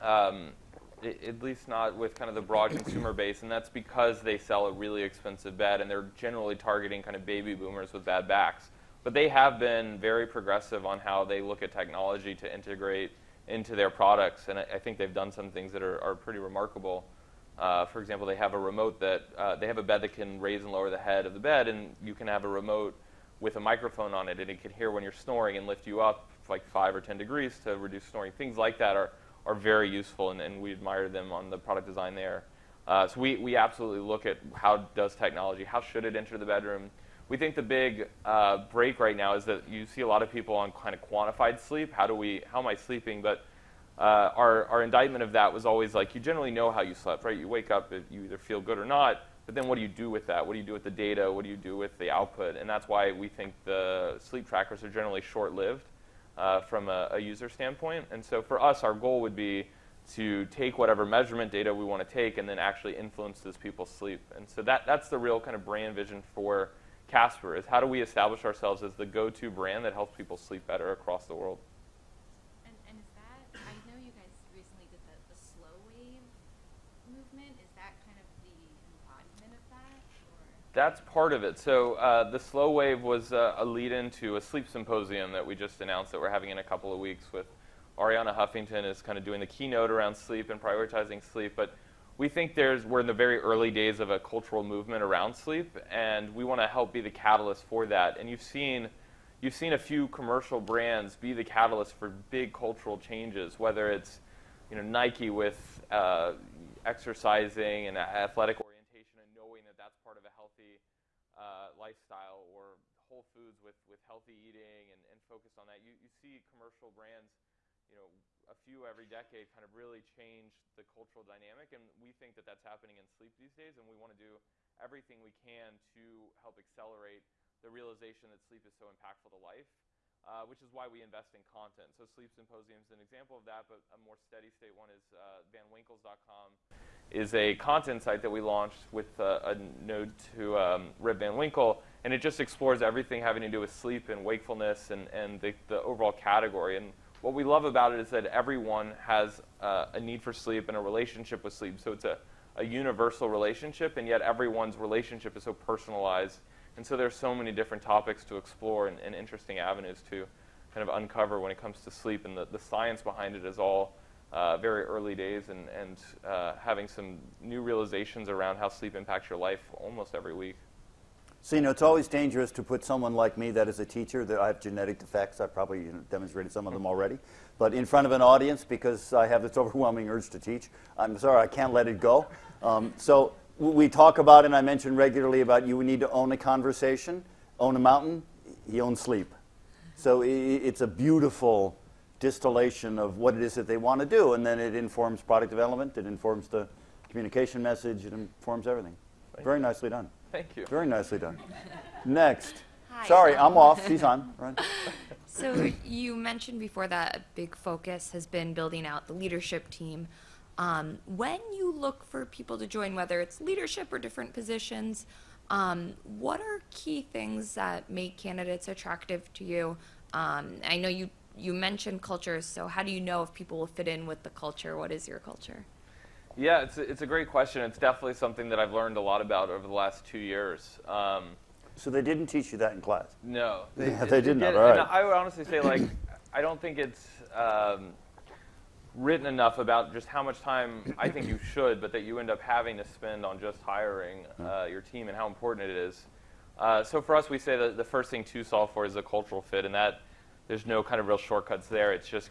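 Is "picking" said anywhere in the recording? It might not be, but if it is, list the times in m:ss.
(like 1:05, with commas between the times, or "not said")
not said.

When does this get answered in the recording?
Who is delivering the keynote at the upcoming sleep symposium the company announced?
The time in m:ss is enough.
1:27.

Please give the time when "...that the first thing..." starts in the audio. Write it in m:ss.
4:07.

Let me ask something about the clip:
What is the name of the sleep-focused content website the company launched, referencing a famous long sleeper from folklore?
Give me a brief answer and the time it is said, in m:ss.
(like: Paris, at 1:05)
VanWinkles.com, at 2:15.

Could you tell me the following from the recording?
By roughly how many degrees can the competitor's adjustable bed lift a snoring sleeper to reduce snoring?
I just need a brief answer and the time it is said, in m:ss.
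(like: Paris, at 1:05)
5 or 10 degrees, at 0:26.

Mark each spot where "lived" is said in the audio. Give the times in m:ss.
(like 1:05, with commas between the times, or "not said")
0:55.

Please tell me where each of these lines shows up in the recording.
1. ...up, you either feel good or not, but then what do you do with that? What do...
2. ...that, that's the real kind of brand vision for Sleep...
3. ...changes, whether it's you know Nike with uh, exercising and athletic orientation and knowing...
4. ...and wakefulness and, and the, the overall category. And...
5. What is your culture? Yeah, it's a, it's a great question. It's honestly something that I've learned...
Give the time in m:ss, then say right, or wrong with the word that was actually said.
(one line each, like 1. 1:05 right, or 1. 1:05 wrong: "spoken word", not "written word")
1. 0:47 right
2. 1:04 wrong: "Casper", not "Sleep"
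3. 1:42 right
4. 2:24 right
5. 3:44 wrong: "definitely", not "honestly".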